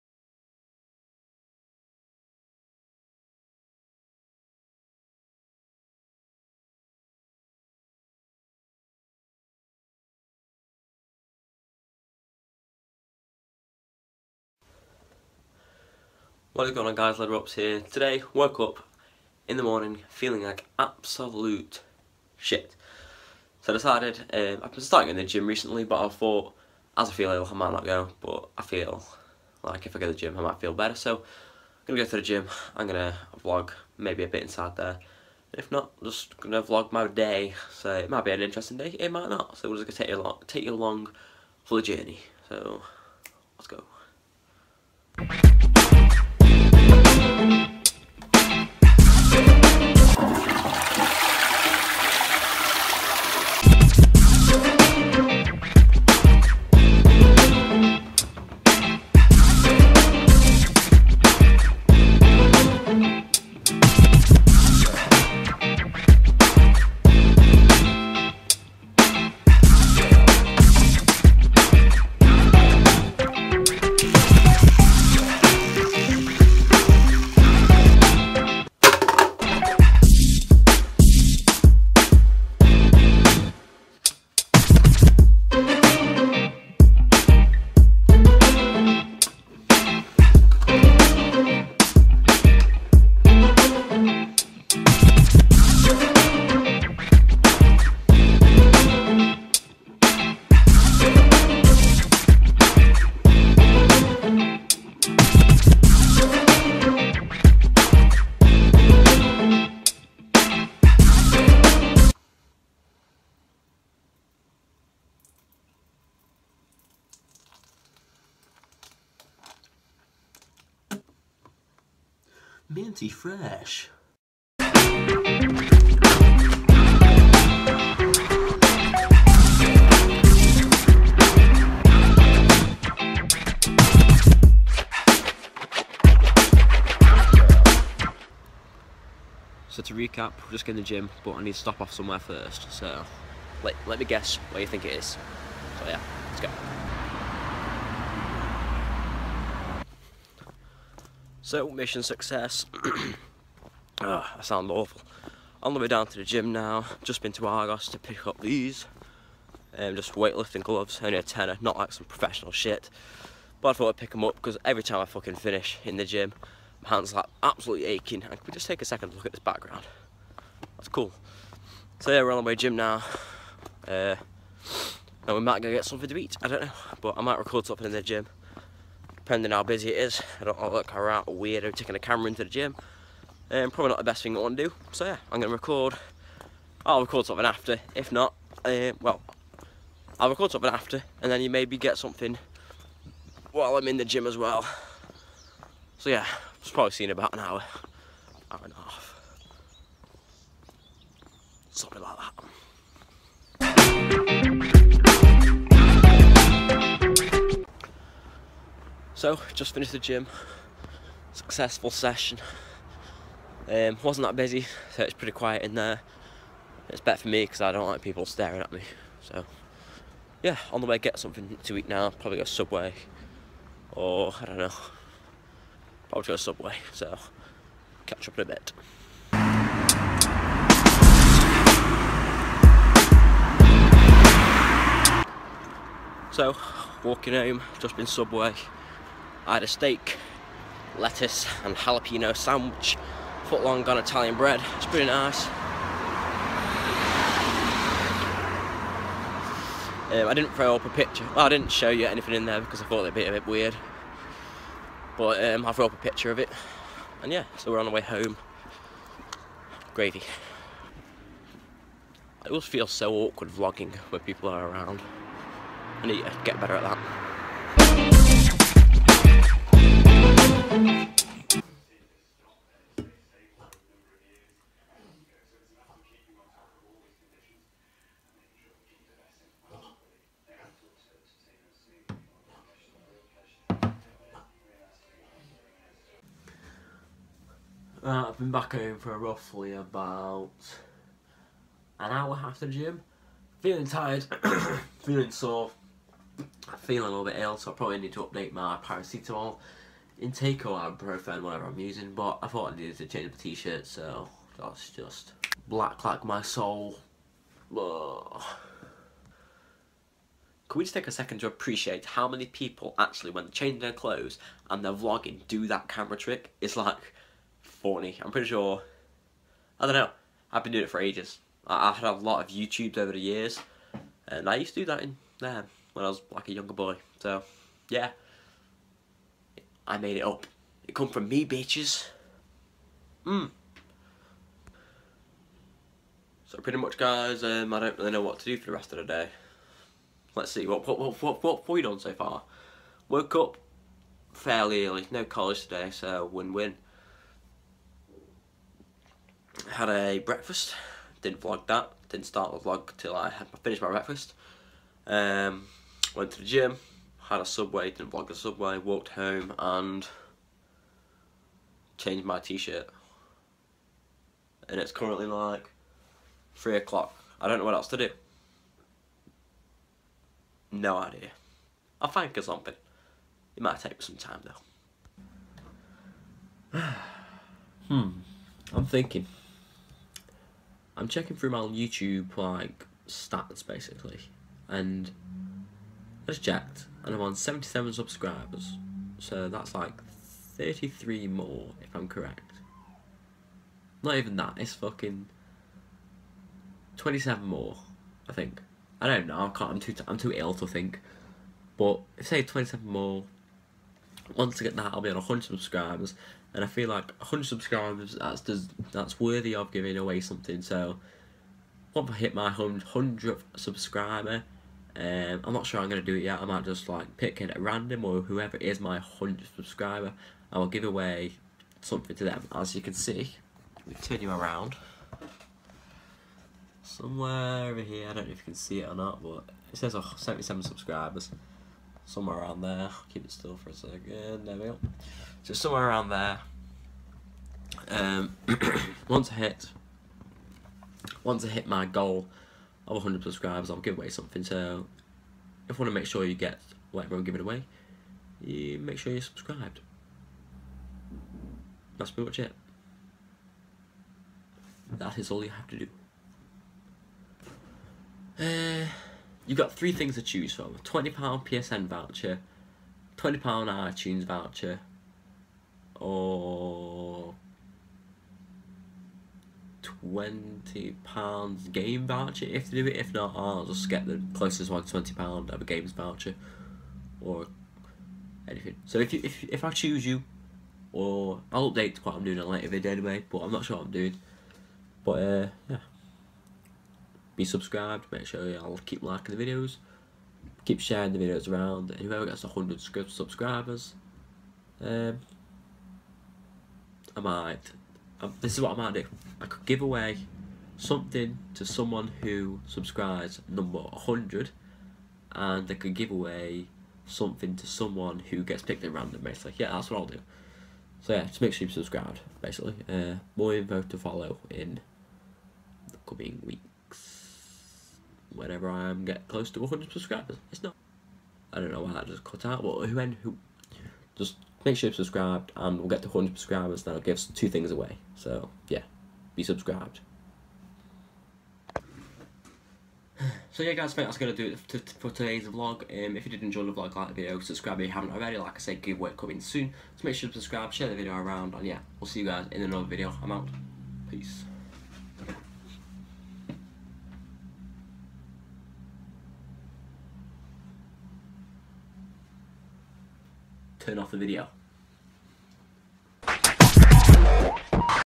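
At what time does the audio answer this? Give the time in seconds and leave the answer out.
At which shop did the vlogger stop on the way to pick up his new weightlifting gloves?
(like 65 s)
157 s.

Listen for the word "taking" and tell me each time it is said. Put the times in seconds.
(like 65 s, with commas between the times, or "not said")
181 s.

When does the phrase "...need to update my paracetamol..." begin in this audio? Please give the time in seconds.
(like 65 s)
297 s.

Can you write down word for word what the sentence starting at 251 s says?
Well, I didn't show you anything in there because I thought it'd be a bit weird.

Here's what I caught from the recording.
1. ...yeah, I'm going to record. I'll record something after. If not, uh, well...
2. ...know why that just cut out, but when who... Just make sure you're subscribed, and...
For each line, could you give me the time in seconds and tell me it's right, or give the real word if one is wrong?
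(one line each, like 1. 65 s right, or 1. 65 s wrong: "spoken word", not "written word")
1. 185 s right
2. 521 s right.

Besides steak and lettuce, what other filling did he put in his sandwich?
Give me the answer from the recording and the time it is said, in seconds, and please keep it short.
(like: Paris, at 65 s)
jalapeno, at 241 s.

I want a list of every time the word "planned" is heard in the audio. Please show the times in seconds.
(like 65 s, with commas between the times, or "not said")
not said.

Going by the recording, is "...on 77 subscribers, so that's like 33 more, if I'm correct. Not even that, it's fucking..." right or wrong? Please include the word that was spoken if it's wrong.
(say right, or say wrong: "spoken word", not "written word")
right.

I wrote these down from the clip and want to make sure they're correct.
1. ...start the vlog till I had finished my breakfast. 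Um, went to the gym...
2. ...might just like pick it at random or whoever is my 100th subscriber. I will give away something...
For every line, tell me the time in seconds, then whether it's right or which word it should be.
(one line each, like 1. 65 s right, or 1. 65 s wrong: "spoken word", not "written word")
1. 352 s right
2. 416 s right.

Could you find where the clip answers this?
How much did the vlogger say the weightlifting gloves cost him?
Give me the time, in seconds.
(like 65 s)
161 s.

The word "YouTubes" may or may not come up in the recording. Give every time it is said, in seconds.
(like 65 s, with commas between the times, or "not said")
322 s, 381 s.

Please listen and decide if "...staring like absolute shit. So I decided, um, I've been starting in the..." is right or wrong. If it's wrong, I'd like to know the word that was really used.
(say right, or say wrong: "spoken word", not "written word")
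wrong: "feeling", not "staring".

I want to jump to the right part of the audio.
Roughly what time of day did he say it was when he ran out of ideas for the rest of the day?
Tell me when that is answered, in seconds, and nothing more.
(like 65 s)
366 s.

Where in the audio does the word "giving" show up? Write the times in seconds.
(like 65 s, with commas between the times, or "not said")
409 s, 447 s.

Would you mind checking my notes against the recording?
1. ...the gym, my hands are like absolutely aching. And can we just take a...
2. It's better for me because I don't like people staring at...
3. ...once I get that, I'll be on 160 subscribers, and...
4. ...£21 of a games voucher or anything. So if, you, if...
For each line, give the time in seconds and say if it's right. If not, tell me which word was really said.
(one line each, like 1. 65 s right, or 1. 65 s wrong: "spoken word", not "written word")
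1. 165 s right
2. 216 s right
3. 404 s wrong: "100", not "160"
4. 474 s wrong: "20", not "21".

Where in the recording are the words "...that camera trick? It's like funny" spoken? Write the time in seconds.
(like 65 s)
315 s.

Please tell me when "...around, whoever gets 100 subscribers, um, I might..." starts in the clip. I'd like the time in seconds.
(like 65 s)
491 s.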